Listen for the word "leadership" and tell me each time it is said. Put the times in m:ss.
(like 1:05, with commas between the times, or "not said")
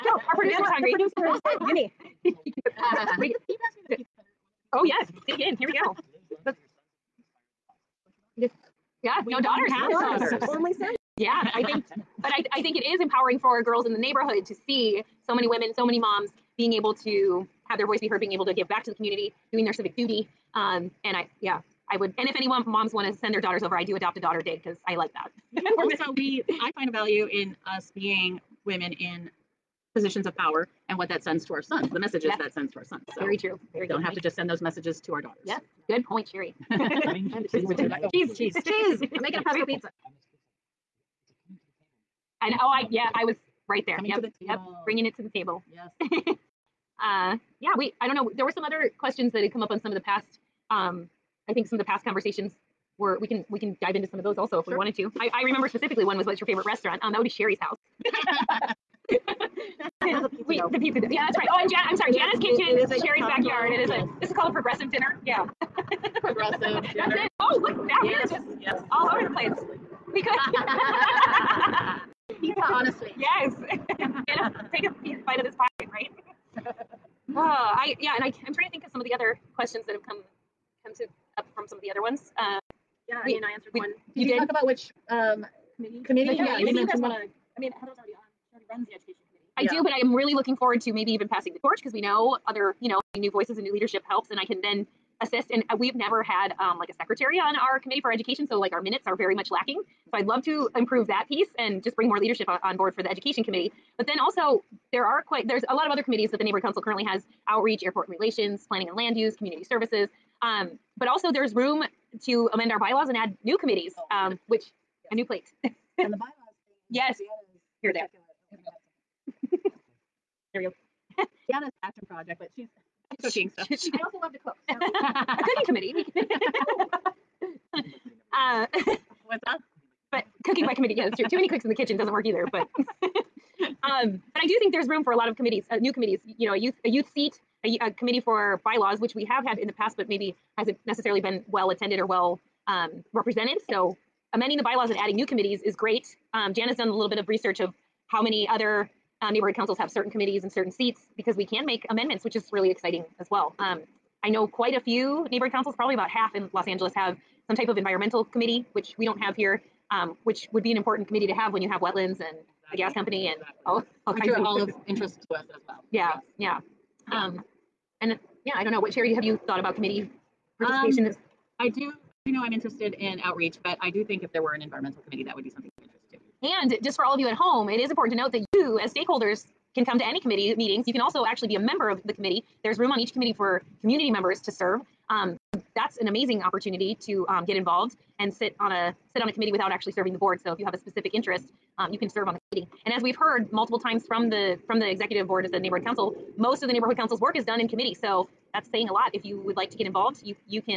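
1:33, 1:42.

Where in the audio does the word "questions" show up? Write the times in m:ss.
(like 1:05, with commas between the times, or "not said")
0:48, 1:19.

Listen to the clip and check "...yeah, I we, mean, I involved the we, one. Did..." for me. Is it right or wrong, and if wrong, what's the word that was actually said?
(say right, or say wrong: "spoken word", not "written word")
wrong: "answered", not "involved".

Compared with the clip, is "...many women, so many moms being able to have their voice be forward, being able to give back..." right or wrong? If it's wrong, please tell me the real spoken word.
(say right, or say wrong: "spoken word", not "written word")
wrong: "heard", not "forward".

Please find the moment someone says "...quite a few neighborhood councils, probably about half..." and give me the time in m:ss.
2:34.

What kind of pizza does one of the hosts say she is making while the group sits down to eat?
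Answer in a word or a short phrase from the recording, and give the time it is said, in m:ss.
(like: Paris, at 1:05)
Pesto pizza, at 0:39.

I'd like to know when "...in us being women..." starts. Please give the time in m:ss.
0:27.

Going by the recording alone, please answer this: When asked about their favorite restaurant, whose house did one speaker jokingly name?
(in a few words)
Sherry's house.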